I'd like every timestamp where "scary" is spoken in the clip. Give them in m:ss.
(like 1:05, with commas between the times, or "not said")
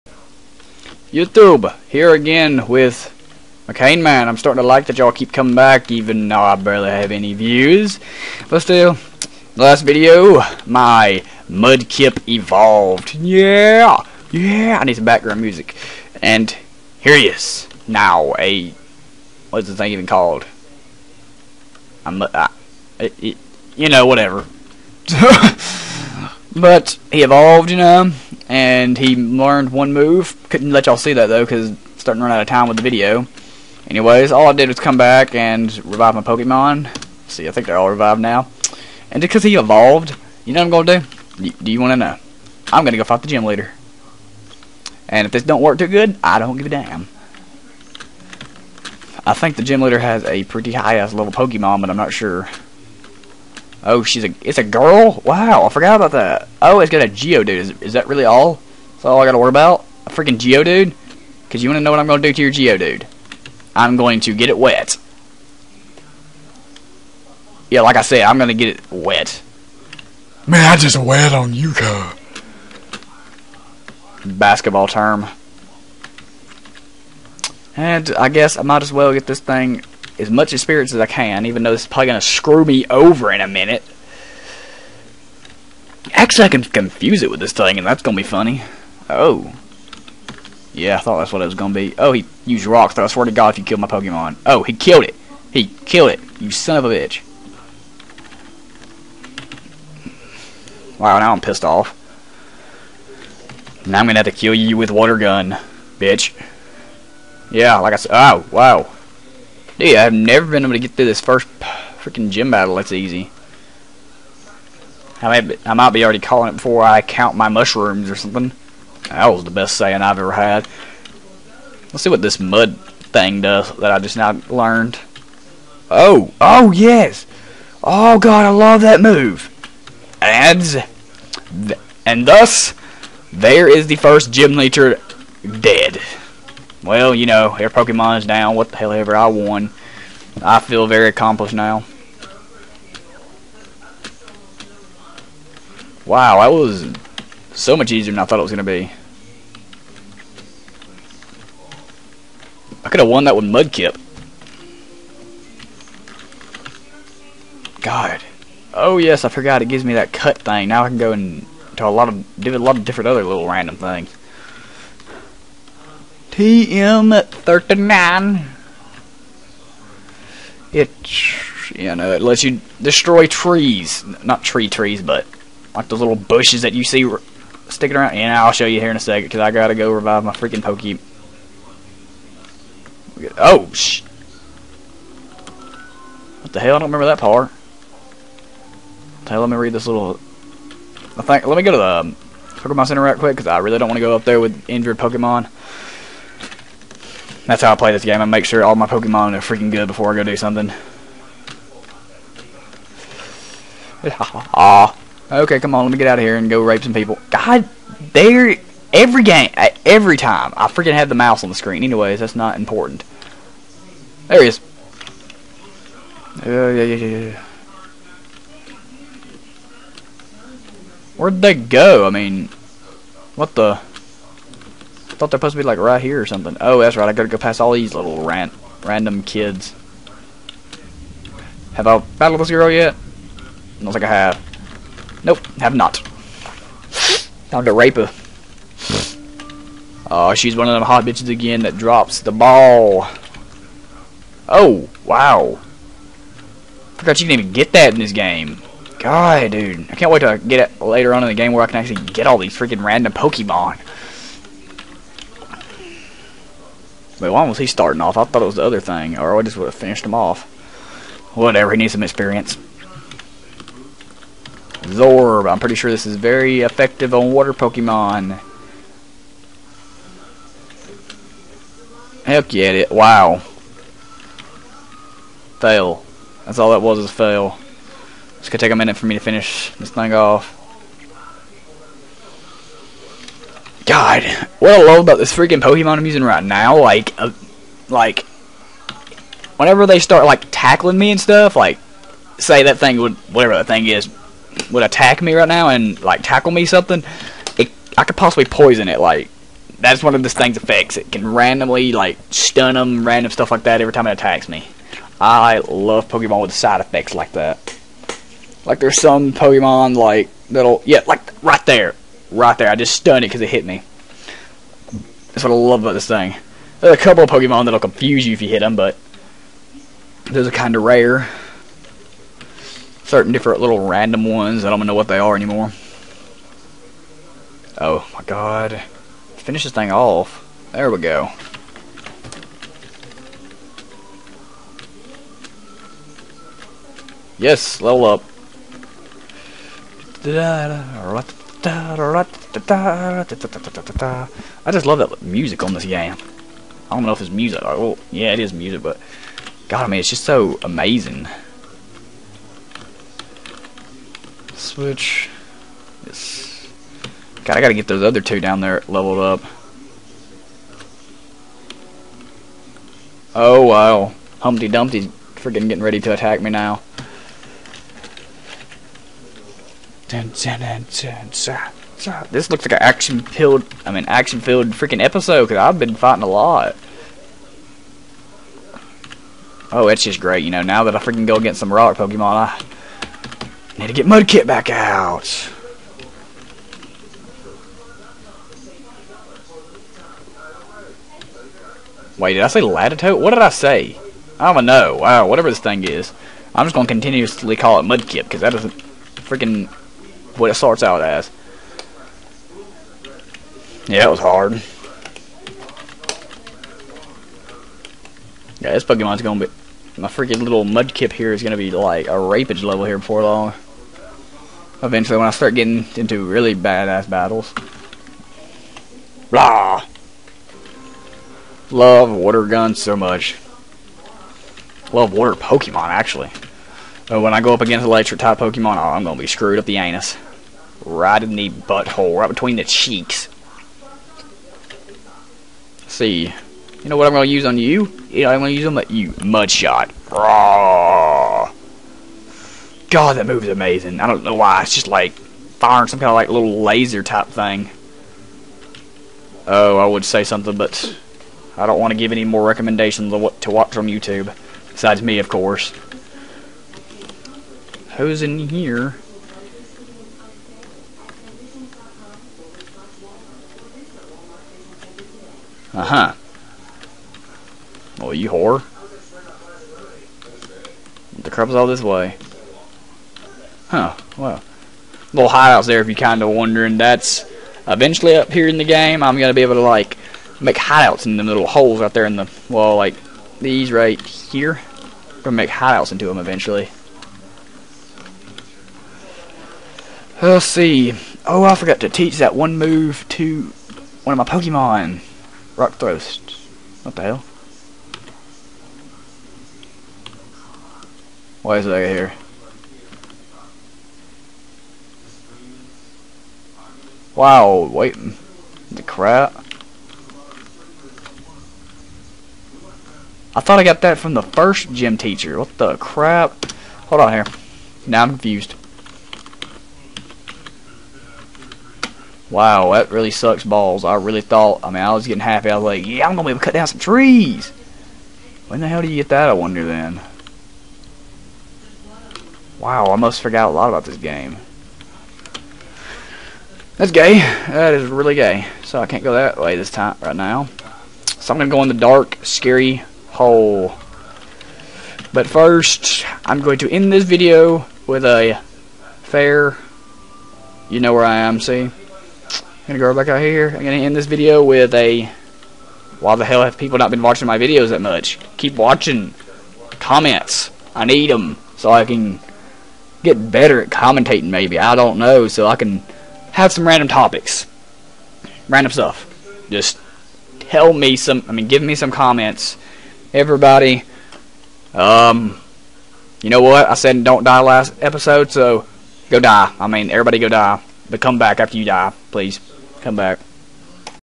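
9:02.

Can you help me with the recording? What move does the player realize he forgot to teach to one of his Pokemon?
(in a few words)
Rock Thrust.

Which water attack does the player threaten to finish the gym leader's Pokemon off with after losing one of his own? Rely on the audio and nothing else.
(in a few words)
Water gun.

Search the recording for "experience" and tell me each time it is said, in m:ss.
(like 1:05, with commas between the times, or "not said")
1:20, 4:22.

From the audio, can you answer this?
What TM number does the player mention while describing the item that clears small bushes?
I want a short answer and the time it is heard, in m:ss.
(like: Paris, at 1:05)
TM39, at 2:46.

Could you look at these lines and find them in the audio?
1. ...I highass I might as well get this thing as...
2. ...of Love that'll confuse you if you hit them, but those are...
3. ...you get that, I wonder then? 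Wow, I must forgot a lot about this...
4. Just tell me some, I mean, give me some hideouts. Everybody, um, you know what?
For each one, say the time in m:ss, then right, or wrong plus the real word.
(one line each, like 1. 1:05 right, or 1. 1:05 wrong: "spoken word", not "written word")
1. 1:18 wrong: "guess", not "highass"
2. 5:17 wrong: "Pokemon", not "Love"
3. 8:48 right
4. 9:29 wrong: "comments", not "hideouts".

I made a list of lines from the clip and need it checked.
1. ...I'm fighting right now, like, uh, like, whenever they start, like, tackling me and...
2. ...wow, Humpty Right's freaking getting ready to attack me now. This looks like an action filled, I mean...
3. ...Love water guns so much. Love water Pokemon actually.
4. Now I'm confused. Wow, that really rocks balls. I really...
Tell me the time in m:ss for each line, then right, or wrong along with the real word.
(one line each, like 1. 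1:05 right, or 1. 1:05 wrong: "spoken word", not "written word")
1. 4:45 wrong: "using", not "fighting"
2. 6:03 wrong: "Dumpty", not "Right"
3. 7:01 right
4. 8:37 wrong: "sucks", not "rocks".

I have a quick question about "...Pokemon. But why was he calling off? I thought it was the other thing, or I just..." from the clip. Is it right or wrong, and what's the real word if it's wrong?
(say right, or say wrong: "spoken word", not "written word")
wrong: "starting", not "calling".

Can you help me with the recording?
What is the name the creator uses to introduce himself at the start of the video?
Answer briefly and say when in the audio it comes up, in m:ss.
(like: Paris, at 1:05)
Mccaneman, at 0:03.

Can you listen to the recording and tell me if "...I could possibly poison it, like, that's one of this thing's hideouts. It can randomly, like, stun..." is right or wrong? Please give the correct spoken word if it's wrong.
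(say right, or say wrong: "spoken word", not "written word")
wrong: "effects", not "hideouts".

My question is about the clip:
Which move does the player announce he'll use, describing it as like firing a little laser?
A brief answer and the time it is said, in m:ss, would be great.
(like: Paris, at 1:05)
Mudshot, at 7:19.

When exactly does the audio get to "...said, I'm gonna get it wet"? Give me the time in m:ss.
1:08.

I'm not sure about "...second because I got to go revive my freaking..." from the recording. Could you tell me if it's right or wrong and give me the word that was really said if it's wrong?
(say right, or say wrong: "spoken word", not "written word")
right.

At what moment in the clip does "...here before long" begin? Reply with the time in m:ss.
6:52.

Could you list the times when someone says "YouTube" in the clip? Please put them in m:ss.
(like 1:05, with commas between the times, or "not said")
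0:01, 7:33.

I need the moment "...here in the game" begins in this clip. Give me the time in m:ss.
7:58.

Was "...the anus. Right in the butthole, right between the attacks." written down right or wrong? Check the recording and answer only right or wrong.
wrong.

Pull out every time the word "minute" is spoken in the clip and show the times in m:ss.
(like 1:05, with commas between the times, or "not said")
1:23, 4:38.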